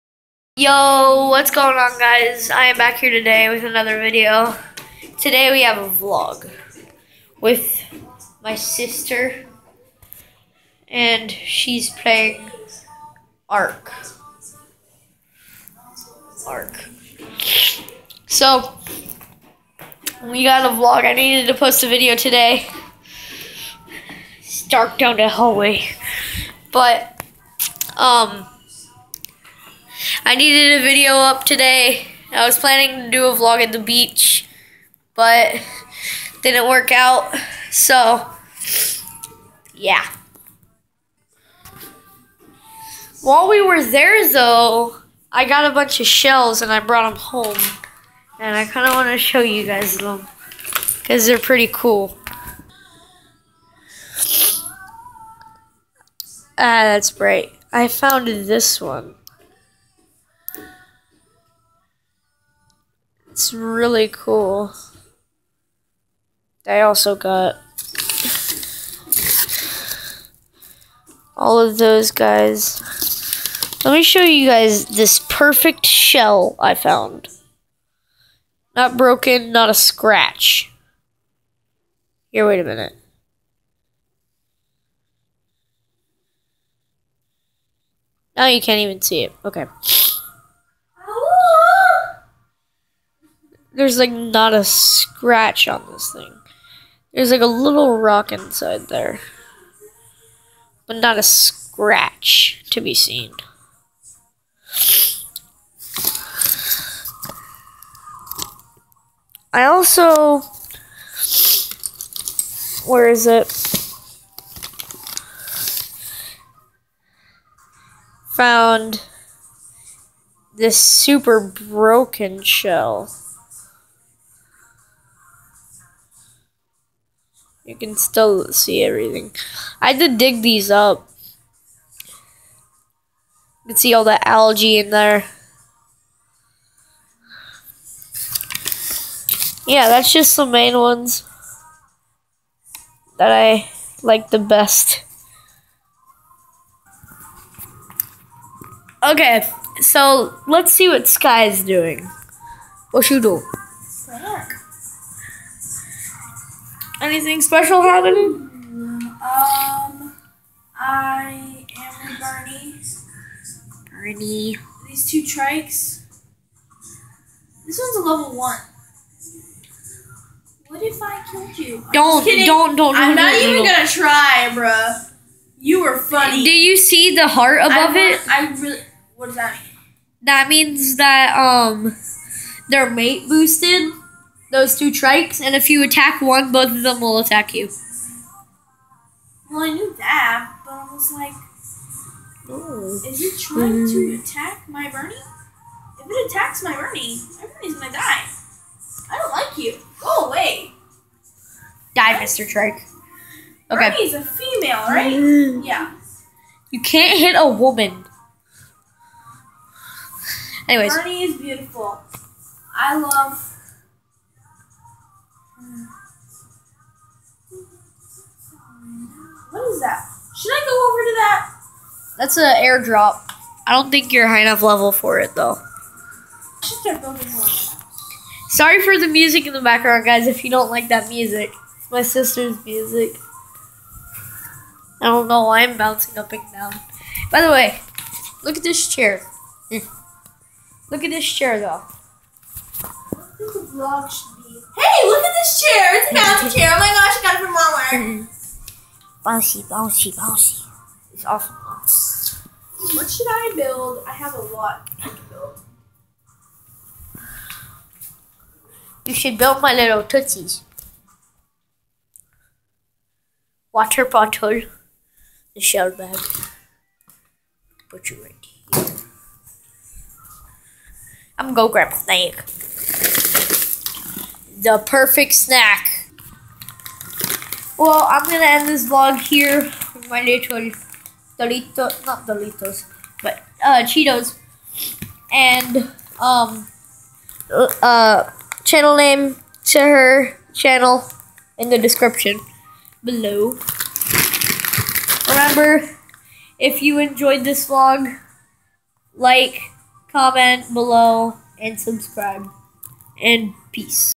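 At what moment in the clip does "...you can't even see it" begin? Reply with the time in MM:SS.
01:28.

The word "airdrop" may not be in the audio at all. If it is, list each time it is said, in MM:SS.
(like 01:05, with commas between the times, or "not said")
03:42.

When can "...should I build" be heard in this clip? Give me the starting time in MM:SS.
04:13.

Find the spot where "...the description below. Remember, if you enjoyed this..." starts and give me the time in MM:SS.
04:51.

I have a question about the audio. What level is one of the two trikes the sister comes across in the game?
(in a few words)
level 1.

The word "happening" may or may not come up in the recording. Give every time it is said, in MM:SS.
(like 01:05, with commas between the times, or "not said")
02:37.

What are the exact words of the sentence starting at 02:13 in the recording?
You can see all the algae in there.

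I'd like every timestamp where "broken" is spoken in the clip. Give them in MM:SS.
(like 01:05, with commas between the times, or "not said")
01:18, 02:01.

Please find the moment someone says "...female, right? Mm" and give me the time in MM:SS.
03:24.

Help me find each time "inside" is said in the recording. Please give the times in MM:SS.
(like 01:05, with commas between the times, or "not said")
01:38.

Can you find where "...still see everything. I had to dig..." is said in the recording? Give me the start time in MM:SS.
02:07.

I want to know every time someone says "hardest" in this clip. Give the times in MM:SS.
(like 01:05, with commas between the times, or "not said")
not said.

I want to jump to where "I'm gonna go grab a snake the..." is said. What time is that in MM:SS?
04:31.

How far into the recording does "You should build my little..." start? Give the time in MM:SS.
04:19.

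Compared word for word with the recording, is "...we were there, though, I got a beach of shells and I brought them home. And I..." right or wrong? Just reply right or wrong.
wrong.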